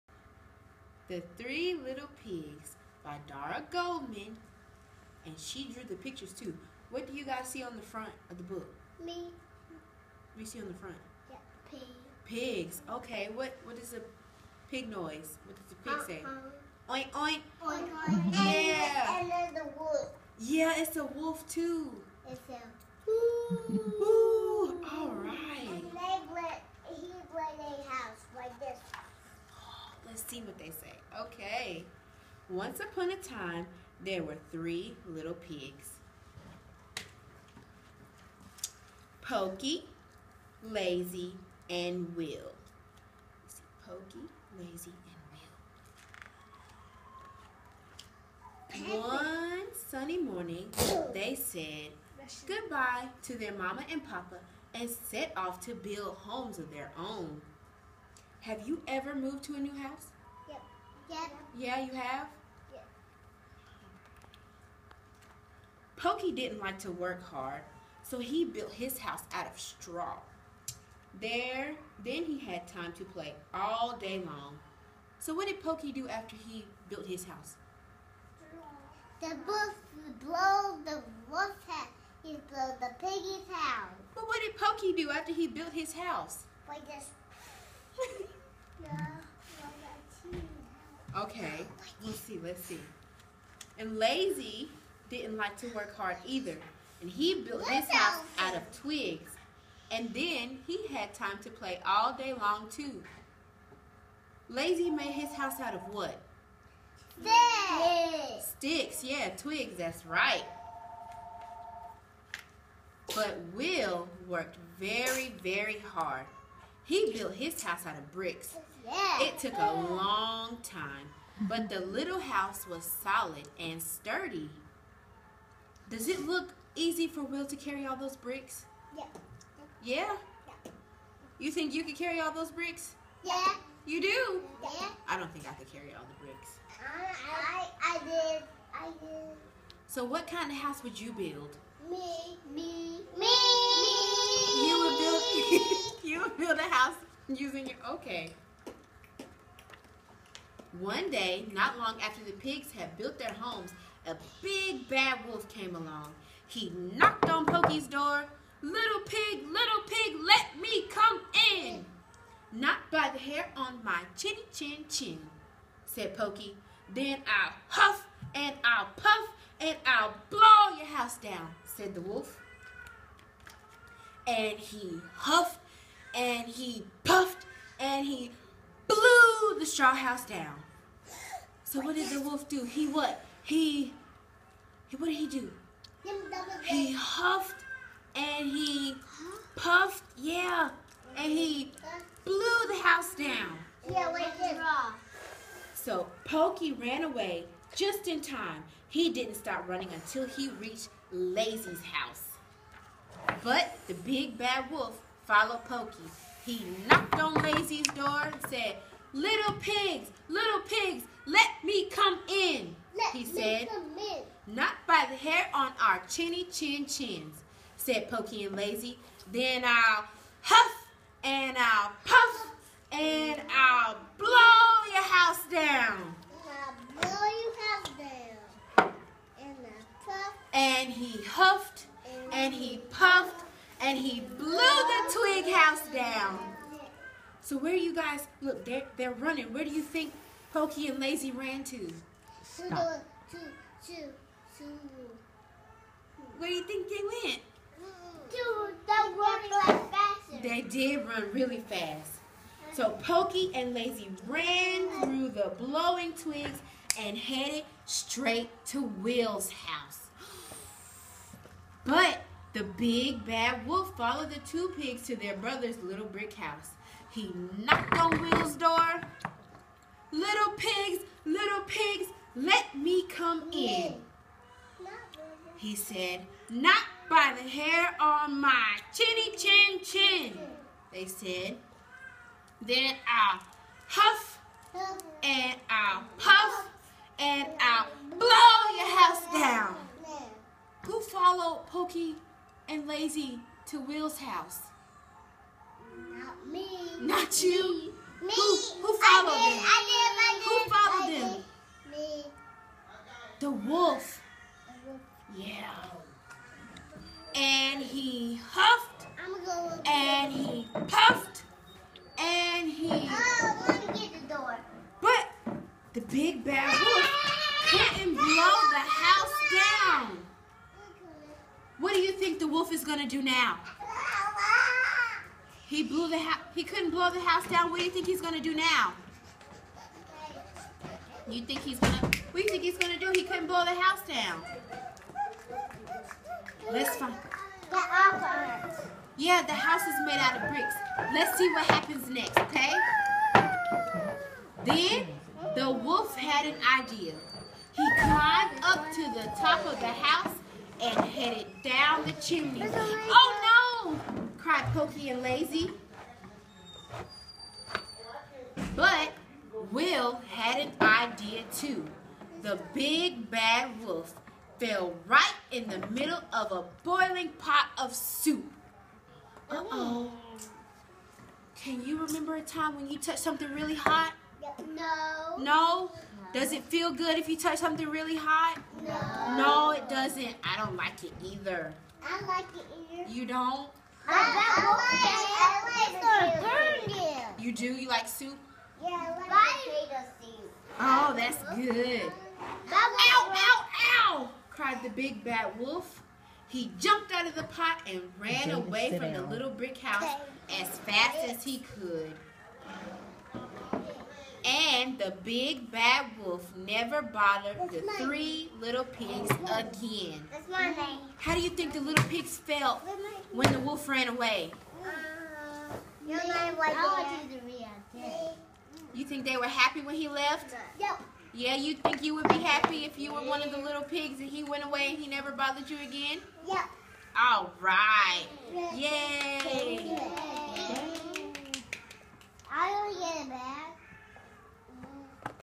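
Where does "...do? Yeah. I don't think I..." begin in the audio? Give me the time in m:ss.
2:14.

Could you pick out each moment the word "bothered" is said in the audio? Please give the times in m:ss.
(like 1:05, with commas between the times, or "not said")
6:47, 7:05.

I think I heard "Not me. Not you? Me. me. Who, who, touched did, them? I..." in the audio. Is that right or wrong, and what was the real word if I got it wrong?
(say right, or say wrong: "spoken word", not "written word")
wrong: "followed", not "touched".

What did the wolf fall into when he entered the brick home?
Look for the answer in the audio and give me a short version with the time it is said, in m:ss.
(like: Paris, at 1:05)
A boiling pot of soup, at 6:06.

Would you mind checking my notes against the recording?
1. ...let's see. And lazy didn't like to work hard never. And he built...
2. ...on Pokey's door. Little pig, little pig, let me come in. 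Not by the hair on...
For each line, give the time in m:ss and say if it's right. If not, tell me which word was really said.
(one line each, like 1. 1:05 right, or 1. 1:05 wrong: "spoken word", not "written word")
1. 1:32 wrong: "either", not "never"
2. 2:37 right.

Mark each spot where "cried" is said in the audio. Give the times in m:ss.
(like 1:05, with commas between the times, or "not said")
5:54, 6:34.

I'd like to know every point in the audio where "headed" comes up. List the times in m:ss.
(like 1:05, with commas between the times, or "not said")
4:17, 5:51.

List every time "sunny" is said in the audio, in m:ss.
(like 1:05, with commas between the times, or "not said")
0:49.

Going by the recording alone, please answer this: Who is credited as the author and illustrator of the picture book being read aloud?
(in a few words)
Dara Goldman.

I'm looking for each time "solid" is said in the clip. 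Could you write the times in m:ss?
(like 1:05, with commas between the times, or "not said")
2:02.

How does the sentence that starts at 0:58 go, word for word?
Have you ever moved to a new house?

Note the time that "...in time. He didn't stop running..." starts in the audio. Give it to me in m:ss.
3:18.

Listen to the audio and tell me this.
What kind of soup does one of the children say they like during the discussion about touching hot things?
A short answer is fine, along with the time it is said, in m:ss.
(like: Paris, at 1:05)
Potato soup, at 6:29.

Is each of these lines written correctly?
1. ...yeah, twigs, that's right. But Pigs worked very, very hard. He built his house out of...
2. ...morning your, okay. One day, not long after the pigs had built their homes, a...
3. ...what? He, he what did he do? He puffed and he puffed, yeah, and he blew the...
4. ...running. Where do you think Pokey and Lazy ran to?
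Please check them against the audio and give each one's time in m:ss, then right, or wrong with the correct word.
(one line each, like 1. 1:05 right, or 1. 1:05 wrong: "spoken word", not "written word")
1. 1:49 wrong: "Will", not "Pigs"
2. 2:27 wrong: "using", not "morning"
3. 3:02 wrong: "huffed", not "puffed"
4. 3:59 right.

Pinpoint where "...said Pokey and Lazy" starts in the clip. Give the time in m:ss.
3:37.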